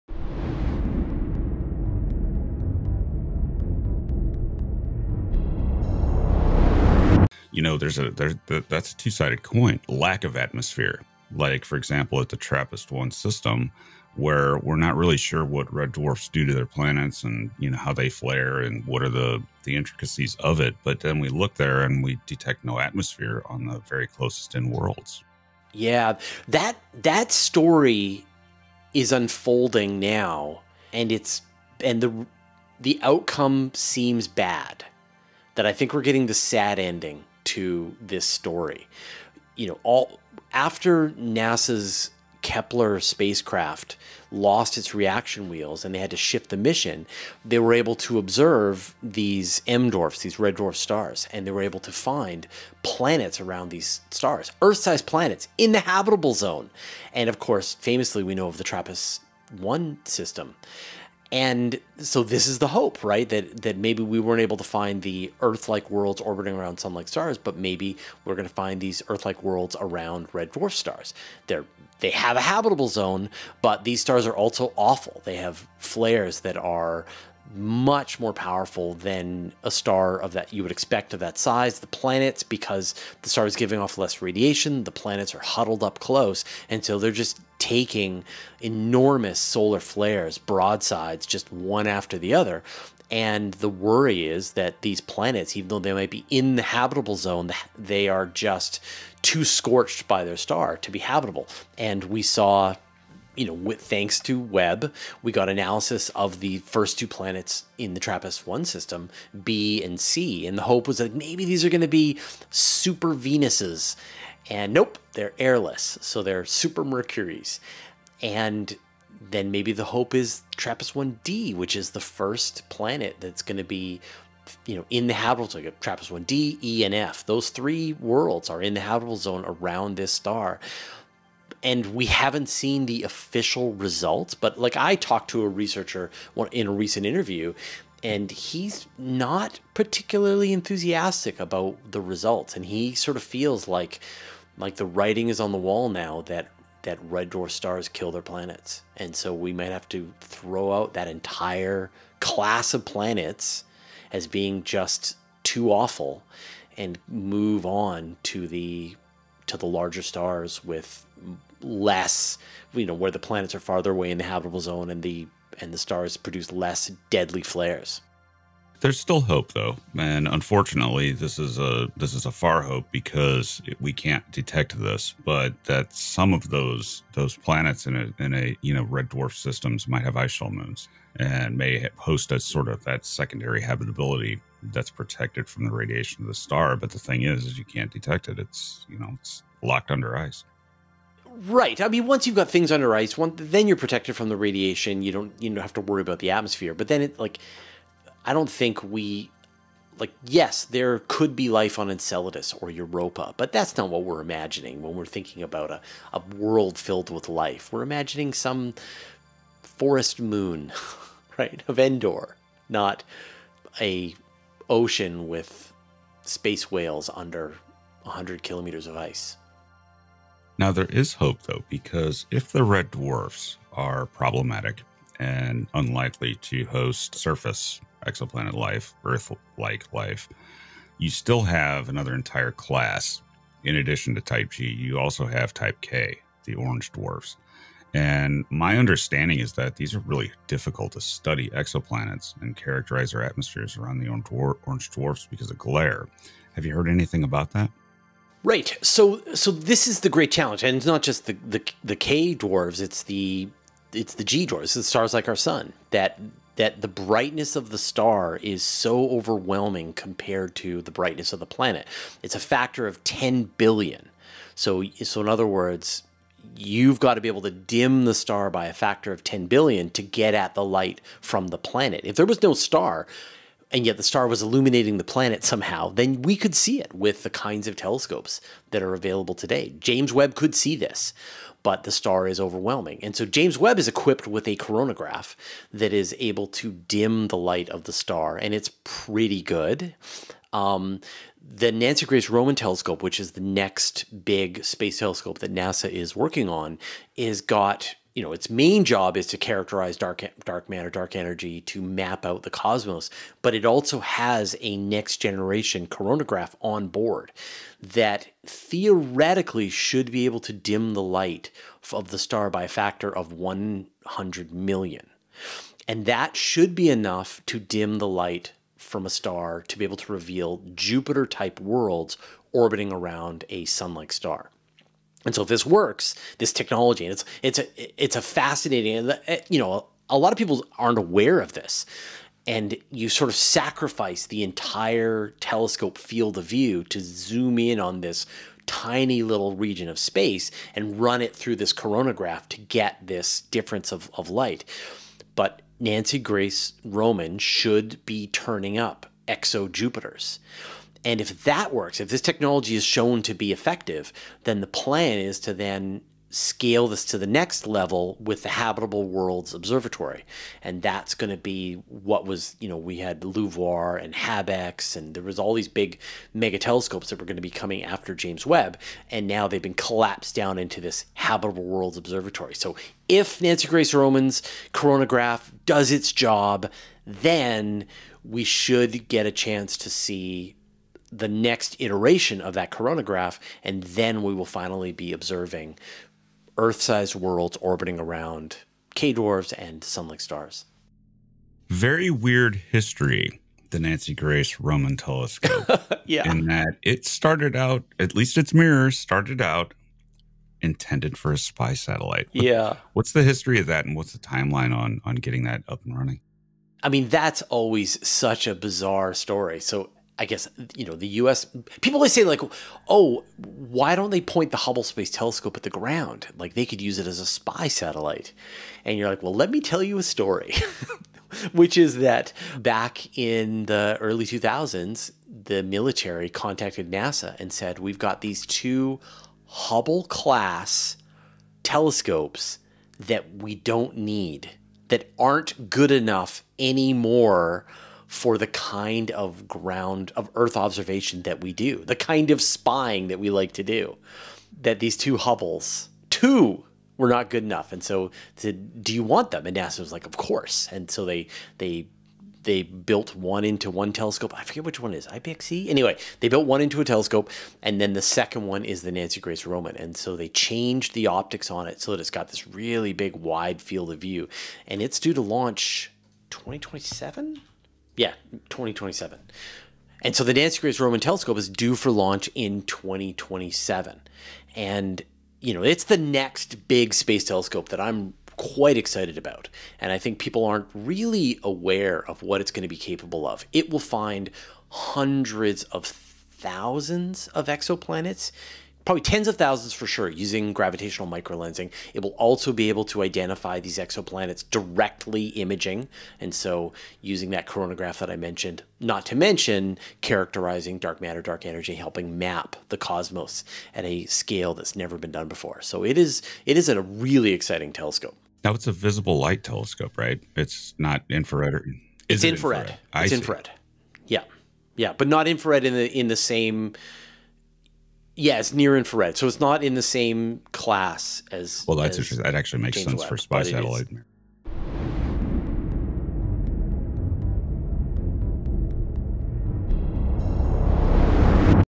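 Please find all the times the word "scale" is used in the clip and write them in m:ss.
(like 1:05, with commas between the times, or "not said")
5:56, 8:24.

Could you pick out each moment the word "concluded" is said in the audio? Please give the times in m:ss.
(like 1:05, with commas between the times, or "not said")
not said.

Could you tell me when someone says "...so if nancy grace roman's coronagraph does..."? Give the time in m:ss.
6:12.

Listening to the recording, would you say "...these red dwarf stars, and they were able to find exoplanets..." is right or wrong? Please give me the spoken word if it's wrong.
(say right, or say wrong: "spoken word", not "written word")
wrong: "planets", not "exoplanets".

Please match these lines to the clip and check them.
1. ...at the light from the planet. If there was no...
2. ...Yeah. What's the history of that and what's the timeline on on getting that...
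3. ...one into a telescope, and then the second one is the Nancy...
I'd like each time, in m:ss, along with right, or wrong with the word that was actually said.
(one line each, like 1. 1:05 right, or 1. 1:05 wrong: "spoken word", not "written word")
1. 4:30 right
2. 6:42 right
3. 7:36 right.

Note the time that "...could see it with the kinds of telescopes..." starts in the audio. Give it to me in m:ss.
4:36.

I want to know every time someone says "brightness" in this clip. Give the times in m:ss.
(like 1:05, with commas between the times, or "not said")
4:16, 4:20.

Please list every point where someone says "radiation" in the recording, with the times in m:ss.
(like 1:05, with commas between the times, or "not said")
1:24, 3:05, 3:14.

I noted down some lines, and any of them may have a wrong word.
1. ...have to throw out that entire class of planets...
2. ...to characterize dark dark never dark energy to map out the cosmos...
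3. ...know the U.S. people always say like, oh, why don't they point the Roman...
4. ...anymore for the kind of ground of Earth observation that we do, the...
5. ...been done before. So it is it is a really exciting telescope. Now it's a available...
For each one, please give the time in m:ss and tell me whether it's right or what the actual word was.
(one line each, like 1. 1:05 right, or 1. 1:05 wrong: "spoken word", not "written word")
1. 2:29 right
2. 4:59 wrong: "matter", not "never"
3. 6:50 wrong: "Hubble", not "Roman"
4. 7:16 right
5. 8:24 wrong: "visible", not "available".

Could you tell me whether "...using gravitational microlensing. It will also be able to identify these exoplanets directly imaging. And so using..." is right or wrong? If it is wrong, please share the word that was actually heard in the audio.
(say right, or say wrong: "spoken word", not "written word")
right.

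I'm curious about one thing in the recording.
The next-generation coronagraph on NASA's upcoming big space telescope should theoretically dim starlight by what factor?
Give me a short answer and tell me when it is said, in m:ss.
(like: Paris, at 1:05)
100 million, at 5:13.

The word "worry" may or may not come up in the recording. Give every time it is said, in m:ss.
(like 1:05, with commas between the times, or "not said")
1:33, 3:15.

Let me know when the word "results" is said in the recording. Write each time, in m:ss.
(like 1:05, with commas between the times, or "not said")
2:13, 2:22.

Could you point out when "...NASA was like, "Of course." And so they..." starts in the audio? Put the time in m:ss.
7:29.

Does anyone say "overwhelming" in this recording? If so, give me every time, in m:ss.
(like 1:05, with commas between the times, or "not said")
4:19, 4:42.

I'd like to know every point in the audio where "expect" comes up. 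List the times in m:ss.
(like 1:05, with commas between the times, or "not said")
1:20.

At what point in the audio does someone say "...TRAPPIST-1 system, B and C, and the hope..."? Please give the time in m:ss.
1:47.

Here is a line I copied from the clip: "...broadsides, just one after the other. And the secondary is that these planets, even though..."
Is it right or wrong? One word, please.
wrong.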